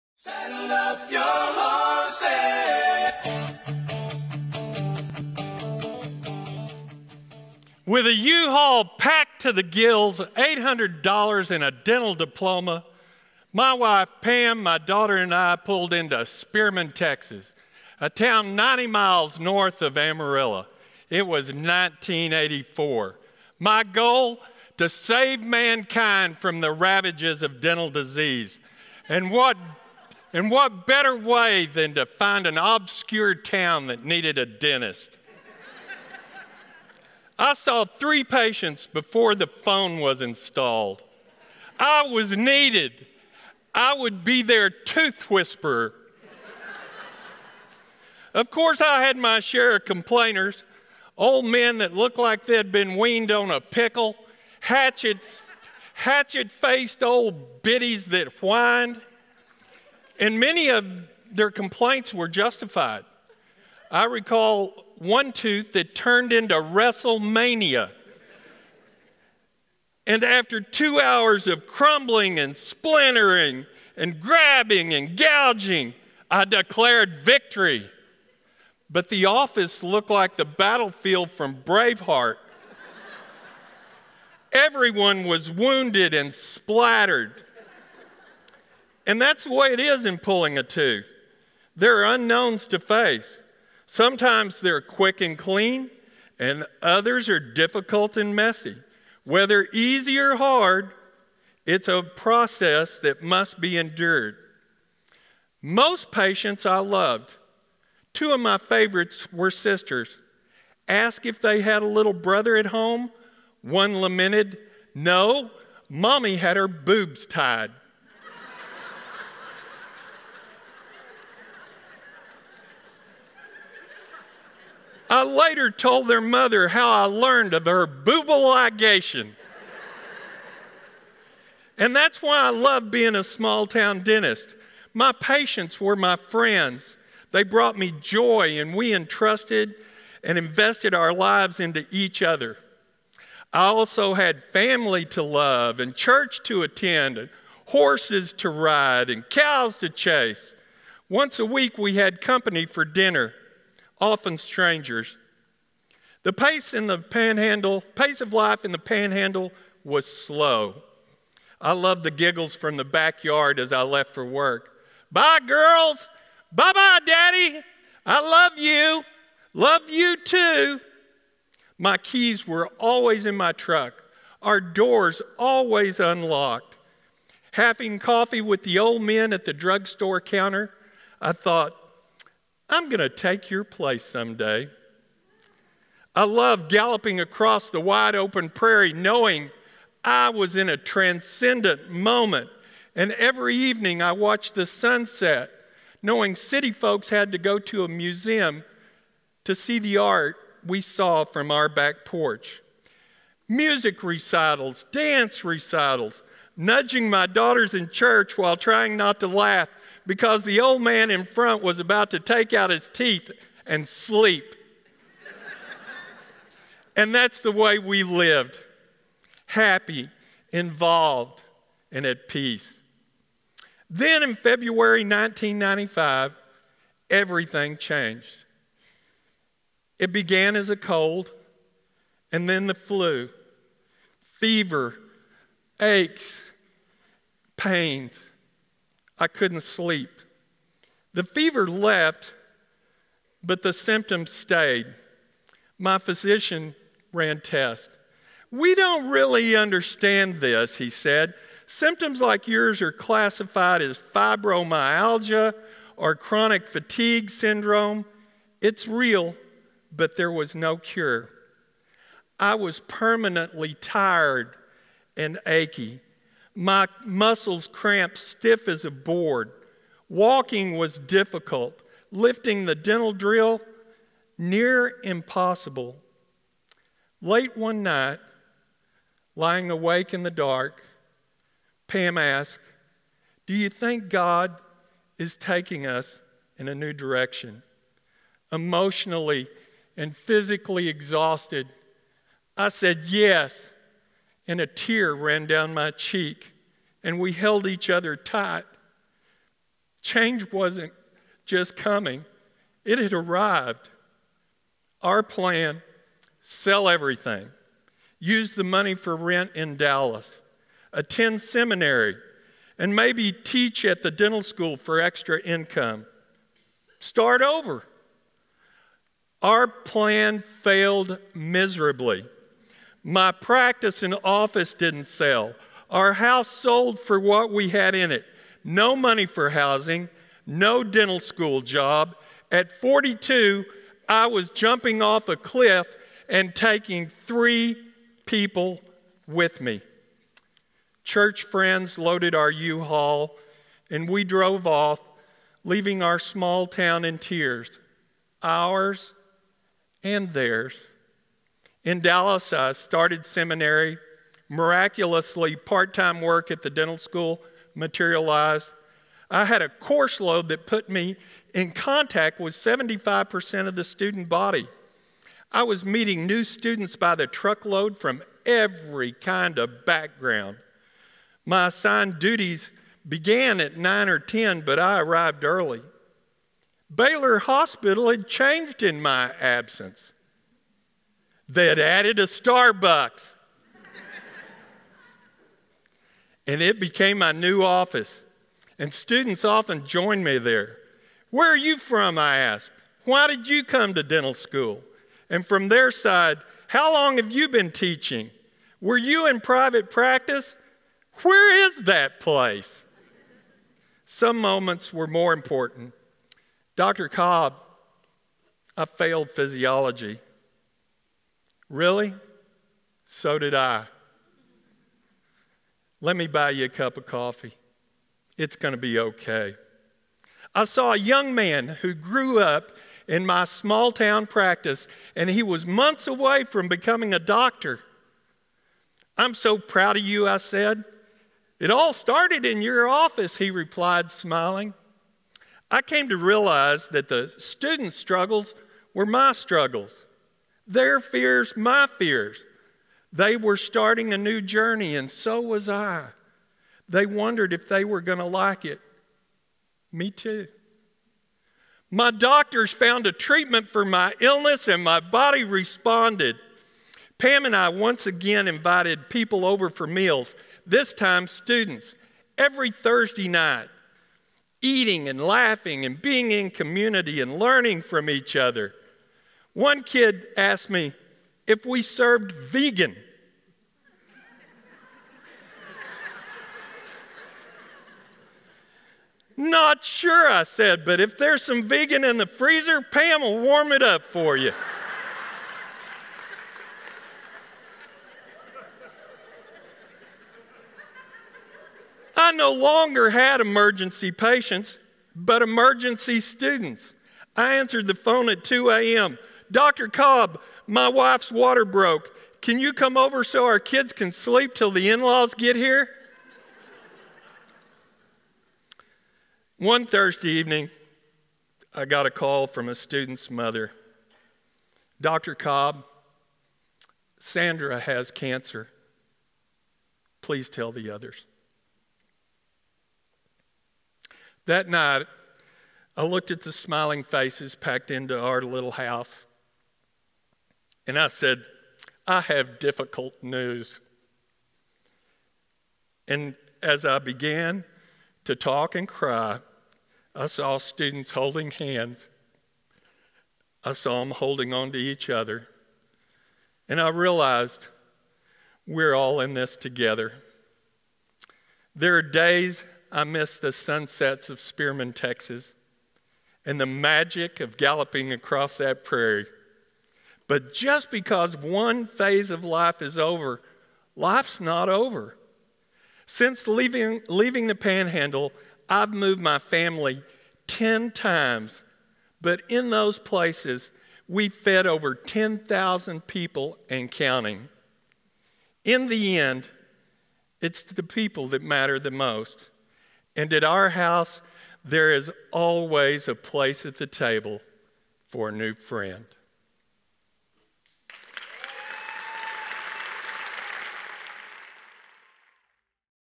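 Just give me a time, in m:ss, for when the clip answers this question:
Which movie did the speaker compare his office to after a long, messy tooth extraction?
1:21.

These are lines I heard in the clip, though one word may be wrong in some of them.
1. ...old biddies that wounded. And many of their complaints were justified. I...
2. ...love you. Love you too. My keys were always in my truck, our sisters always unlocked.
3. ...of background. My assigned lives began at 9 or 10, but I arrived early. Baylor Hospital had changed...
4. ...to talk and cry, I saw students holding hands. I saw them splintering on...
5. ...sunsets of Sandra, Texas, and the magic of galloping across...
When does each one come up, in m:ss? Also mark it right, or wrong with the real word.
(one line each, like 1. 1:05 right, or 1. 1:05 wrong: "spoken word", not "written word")
1. 0:57 wrong: "whined", not "wounded"
2. 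2:48 wrong: "doors", not "sisters"
3. 6:09 wrong: "duties", not "lives"
4. 8:58 wrong: "holding", not "splintering"
5. 9:13 wrong: "Spearman", not "Sandra".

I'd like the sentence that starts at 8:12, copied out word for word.
I no longer had emergency patients, but emergency students.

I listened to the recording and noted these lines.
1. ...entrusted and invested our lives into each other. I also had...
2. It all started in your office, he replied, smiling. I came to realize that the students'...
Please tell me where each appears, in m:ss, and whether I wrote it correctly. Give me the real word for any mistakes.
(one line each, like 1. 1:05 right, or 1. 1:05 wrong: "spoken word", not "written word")
1. 2:18 right
2. 7:11 right.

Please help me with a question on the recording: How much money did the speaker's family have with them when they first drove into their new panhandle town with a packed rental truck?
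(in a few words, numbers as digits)
$800.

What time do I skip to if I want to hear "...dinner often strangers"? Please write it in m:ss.
2:32.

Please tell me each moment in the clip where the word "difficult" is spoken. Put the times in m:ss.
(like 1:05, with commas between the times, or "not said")
1:37, 4:30, 8:52.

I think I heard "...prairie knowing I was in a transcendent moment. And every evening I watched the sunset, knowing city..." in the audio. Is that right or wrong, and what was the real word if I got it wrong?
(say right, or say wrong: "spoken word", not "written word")
right.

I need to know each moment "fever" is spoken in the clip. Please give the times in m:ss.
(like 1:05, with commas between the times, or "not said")
3:54, 4:01.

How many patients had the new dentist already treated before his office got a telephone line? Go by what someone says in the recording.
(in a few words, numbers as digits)
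3.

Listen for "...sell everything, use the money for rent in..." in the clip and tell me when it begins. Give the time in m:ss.
5:06.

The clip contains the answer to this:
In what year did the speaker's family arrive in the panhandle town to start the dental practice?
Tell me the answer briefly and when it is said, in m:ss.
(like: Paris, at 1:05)
1984, at 0:21.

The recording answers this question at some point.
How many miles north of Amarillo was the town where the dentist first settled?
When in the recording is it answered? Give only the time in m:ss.
0:18.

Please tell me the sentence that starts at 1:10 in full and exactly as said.
And after two hours of crumbling and splintering and grabbing and gouging, I declared victory.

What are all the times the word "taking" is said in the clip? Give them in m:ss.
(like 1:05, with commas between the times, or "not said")
4:45, 5:36.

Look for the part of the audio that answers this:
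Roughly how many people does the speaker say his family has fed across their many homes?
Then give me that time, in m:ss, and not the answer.
9:34.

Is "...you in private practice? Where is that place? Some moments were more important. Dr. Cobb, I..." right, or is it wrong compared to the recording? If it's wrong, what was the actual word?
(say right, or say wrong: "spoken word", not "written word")
right.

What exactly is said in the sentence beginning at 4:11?
Symptoms like yours are classified as fibromyalgia or chronic fatigue syndrome.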